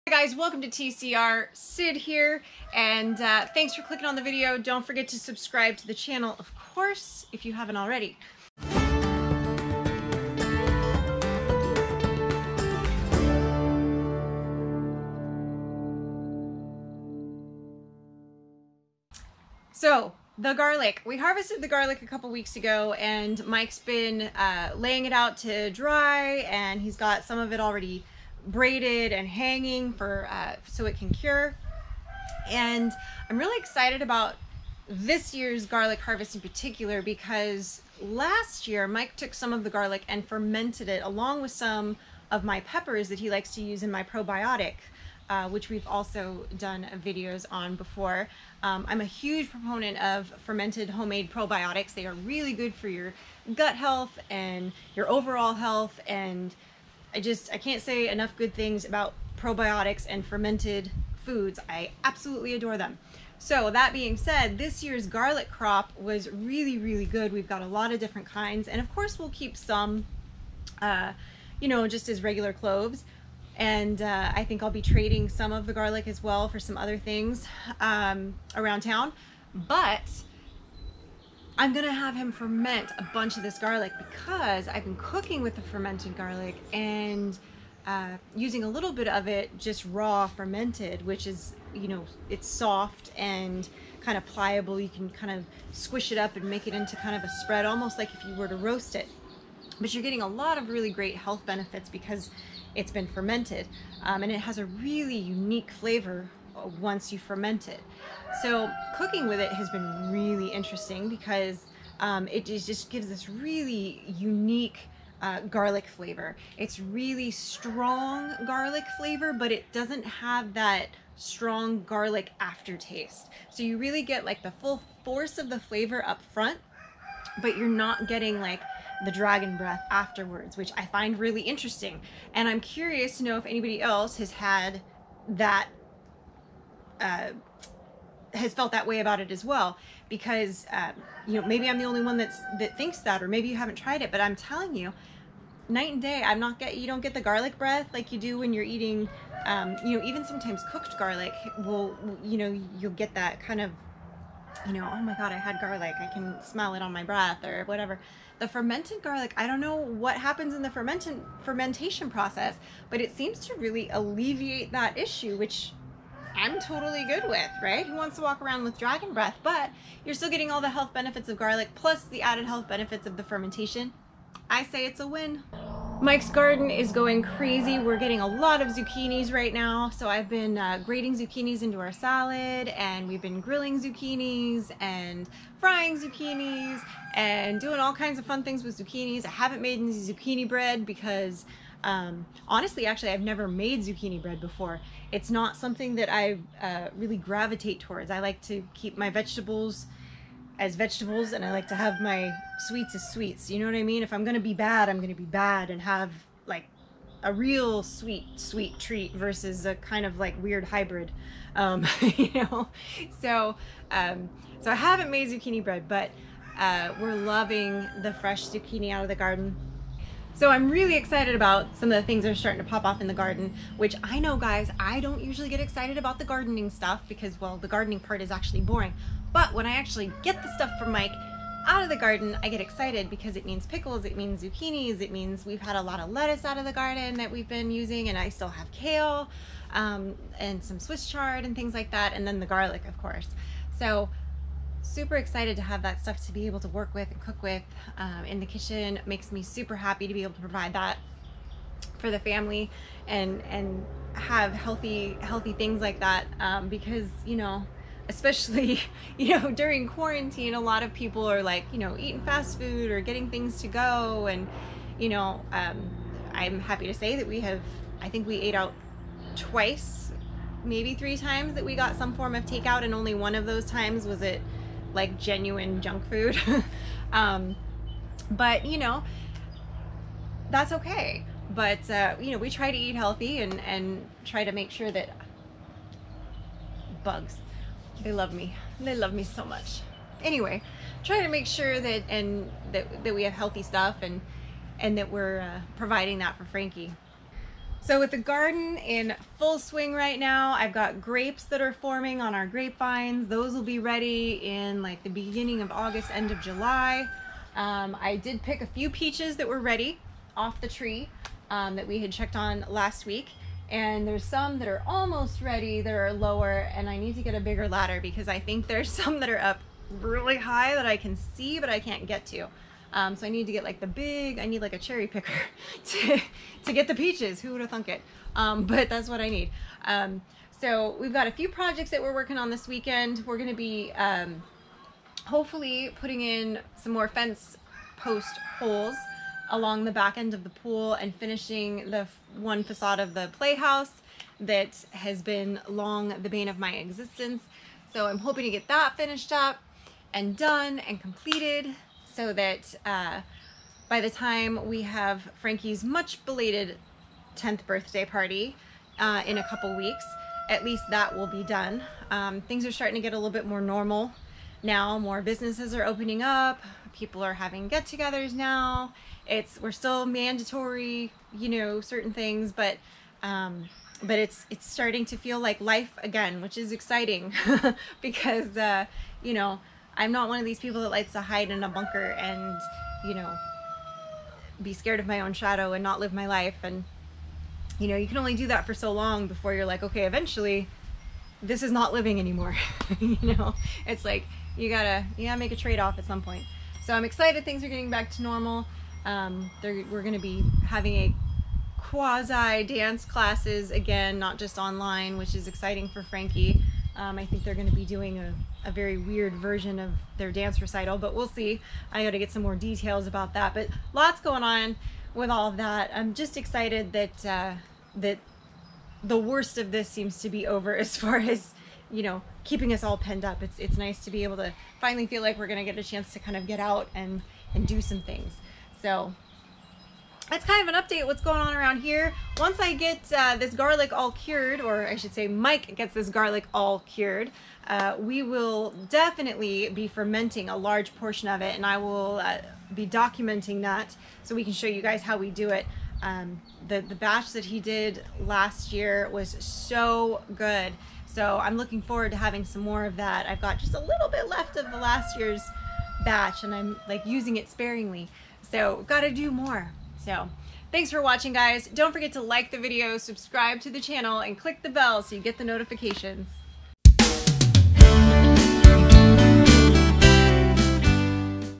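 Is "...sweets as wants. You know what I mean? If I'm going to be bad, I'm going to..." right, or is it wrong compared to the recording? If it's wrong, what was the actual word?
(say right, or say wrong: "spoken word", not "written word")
wrong: "sweets", not "wants".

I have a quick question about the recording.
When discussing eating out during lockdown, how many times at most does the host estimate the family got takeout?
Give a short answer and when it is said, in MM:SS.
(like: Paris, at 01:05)
3, at 04:30.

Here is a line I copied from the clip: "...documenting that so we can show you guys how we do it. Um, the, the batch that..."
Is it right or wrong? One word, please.
right.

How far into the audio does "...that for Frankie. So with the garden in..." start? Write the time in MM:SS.
04:56.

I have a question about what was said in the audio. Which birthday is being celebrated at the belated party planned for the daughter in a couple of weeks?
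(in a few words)
10th.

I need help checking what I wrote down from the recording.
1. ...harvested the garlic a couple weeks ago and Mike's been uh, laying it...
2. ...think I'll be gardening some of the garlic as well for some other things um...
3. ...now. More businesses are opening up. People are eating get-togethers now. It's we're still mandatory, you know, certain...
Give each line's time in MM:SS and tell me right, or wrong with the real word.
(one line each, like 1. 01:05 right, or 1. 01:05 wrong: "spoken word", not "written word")
1. 00:21 right
2. 01:14 wrong: "trading", not "gardening"
3. 06:04 wrong: "having", not "eating".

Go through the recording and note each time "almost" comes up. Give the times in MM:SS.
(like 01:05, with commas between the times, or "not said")
01:37, 05:14.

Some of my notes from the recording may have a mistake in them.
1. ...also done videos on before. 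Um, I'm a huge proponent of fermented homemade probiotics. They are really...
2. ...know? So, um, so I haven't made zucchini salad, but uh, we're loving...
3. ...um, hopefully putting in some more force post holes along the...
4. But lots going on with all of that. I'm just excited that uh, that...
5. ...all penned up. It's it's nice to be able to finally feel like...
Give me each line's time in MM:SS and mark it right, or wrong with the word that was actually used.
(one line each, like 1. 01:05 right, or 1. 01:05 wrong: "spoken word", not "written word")
1. 00:45 right
2. 03:32 wrong: "bread", not "salad"
3. 05:33 wrong: "fence", not "force"
4. 06:53 right
5. 07:02 right.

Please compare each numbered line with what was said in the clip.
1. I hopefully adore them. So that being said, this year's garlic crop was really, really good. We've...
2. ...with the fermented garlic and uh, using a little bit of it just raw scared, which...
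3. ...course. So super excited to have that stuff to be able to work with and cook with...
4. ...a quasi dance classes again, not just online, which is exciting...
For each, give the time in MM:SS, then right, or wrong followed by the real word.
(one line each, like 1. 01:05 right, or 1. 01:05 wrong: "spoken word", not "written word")
1. 01:01 wrong: "absolutely", not "hopefully"
2. 01:25 wrong: "fermented", not "scared"
3. 04:02 right
4. 06:40 right.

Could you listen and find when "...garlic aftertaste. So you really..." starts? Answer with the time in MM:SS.
02:01.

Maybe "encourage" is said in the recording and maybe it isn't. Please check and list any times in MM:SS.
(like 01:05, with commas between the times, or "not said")
not said.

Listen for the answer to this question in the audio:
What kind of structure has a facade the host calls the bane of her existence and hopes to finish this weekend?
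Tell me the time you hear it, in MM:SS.
05:43.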